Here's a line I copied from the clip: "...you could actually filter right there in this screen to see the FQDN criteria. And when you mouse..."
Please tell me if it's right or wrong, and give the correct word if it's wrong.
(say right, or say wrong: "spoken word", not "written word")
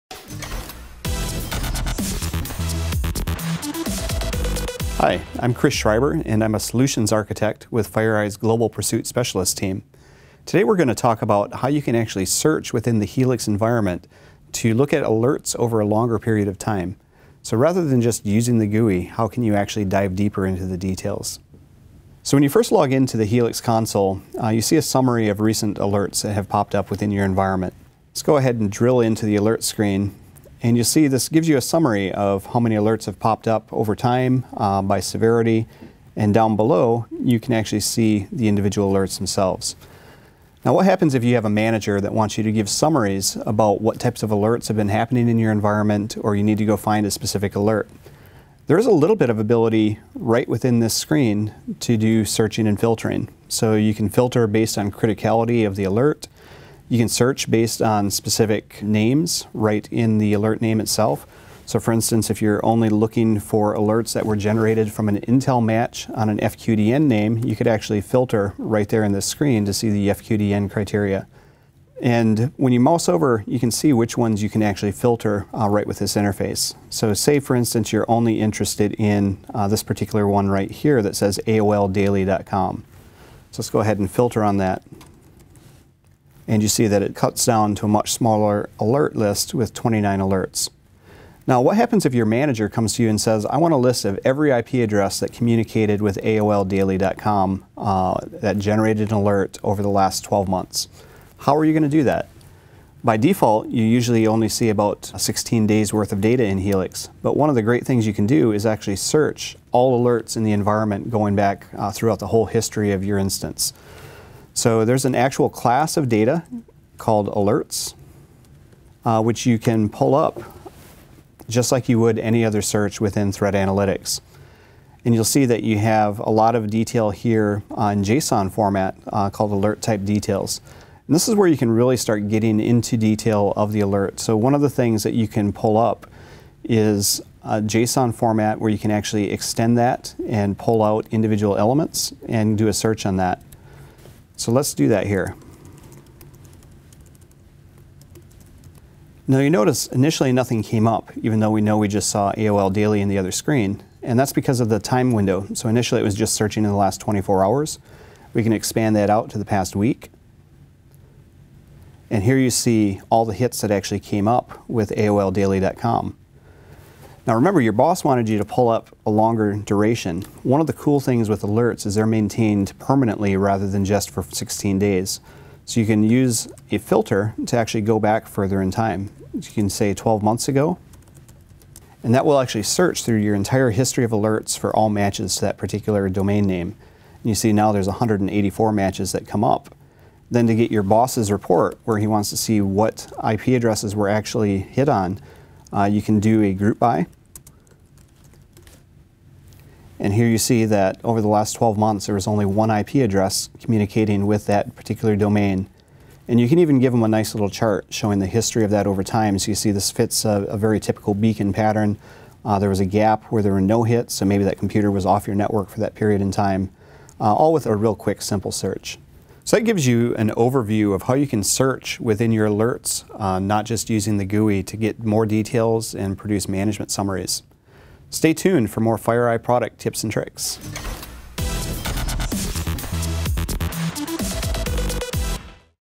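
right.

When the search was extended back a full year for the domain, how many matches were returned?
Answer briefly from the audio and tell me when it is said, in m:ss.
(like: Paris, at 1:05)
184, at 3:07.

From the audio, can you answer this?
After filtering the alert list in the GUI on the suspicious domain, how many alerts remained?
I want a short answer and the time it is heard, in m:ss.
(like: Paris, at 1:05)
29, at 1:29.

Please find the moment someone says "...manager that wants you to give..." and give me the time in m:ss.
0:41.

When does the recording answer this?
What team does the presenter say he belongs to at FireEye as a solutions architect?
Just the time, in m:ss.
0:08.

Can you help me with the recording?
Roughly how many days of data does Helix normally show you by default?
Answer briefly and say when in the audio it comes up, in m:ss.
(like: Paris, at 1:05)
16, at 1:44.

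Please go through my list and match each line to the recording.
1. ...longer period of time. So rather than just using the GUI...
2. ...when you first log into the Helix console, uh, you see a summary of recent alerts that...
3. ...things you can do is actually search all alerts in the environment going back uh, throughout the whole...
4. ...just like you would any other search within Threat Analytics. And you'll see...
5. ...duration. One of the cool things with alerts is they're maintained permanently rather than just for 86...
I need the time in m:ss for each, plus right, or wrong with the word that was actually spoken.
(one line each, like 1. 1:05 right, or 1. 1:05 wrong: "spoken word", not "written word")
1. 0:15 right
2. 0:22 right
3. 1:47 right
4. 2:01 right
5. 2:49 wrong: "16", not "86".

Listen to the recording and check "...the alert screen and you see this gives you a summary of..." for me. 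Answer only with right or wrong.
right.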